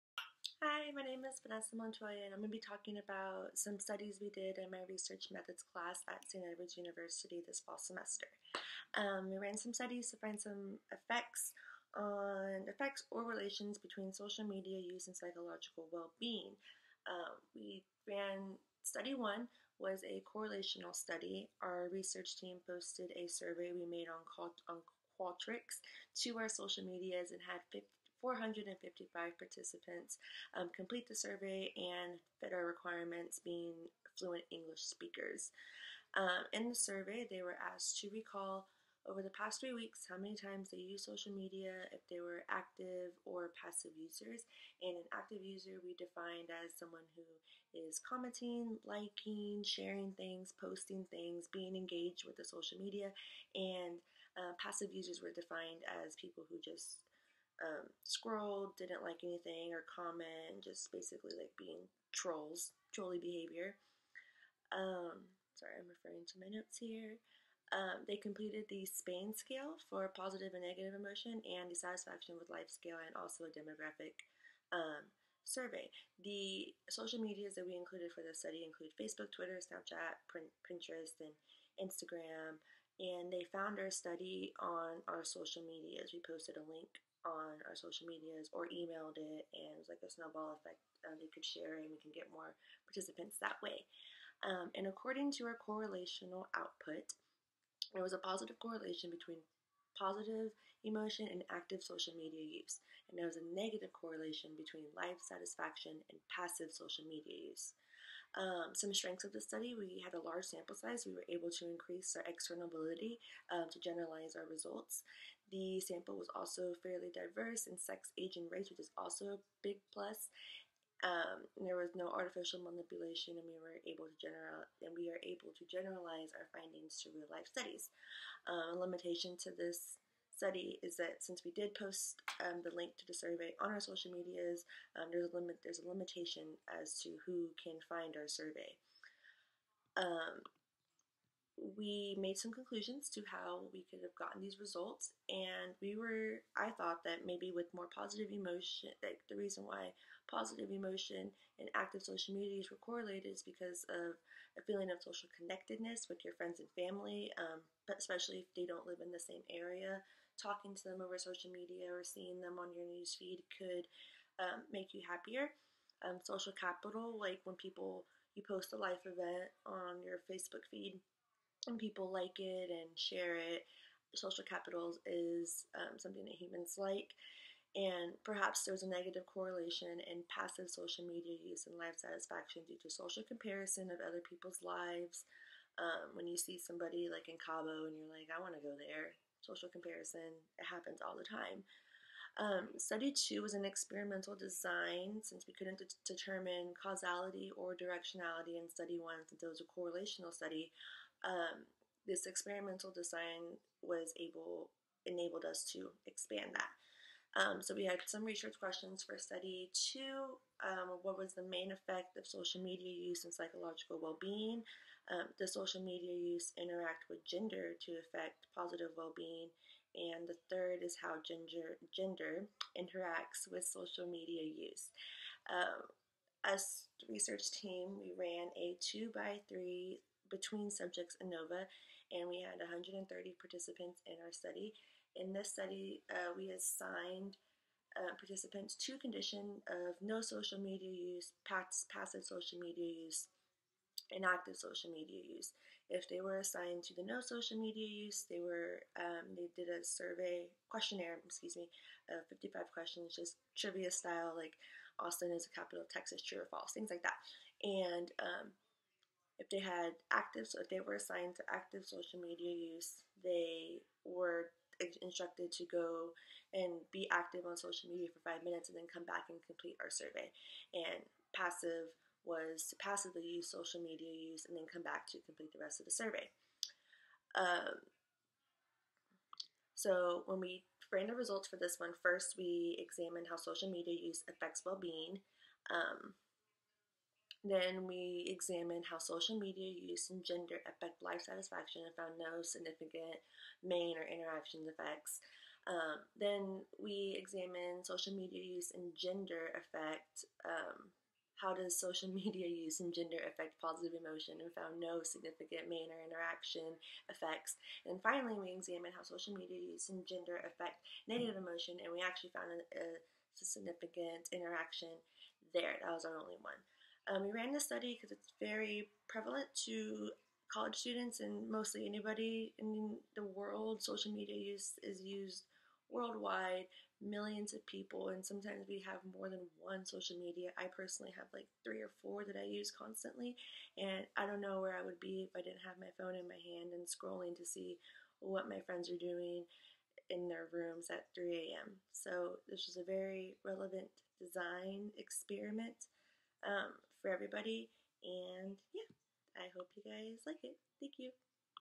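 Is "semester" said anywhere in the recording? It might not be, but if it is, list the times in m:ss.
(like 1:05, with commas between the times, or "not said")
0:07.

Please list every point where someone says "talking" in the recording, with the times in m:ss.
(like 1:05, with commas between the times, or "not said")
0:02, 2:40.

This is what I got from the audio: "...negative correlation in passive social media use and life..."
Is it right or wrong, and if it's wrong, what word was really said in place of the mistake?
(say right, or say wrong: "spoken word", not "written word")
right.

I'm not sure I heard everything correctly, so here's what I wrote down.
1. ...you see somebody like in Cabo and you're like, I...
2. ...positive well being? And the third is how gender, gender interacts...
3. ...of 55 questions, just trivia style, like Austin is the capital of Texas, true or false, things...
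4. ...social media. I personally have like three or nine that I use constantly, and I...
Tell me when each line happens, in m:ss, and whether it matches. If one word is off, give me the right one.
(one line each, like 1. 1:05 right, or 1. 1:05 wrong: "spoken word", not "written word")
1. 3:06 right
2. 3:38 right
3. 4:12 right
4. 5:29 wrong: "four", not "nine".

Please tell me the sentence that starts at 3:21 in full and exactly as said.
Um, this experimental design was able enabled us to expand that.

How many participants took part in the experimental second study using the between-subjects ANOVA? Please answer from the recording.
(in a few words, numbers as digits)
130.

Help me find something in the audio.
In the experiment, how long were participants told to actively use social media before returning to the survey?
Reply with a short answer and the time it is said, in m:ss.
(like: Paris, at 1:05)
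5 minutes, at 4:28.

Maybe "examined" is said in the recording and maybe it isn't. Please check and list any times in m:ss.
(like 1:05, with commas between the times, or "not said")
4:42, 4:48, 4:57, 5:08.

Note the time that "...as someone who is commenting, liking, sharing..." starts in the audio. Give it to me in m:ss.
0:46.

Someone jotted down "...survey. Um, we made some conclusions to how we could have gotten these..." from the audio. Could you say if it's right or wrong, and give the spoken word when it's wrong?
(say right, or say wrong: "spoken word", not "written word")
right.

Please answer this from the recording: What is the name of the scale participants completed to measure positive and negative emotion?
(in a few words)
SPANE.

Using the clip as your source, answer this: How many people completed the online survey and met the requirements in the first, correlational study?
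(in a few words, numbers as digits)
455.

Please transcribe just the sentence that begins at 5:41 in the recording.
So this was a very relevant design experiment um, for everybody, and yeah, I hope you guys like it.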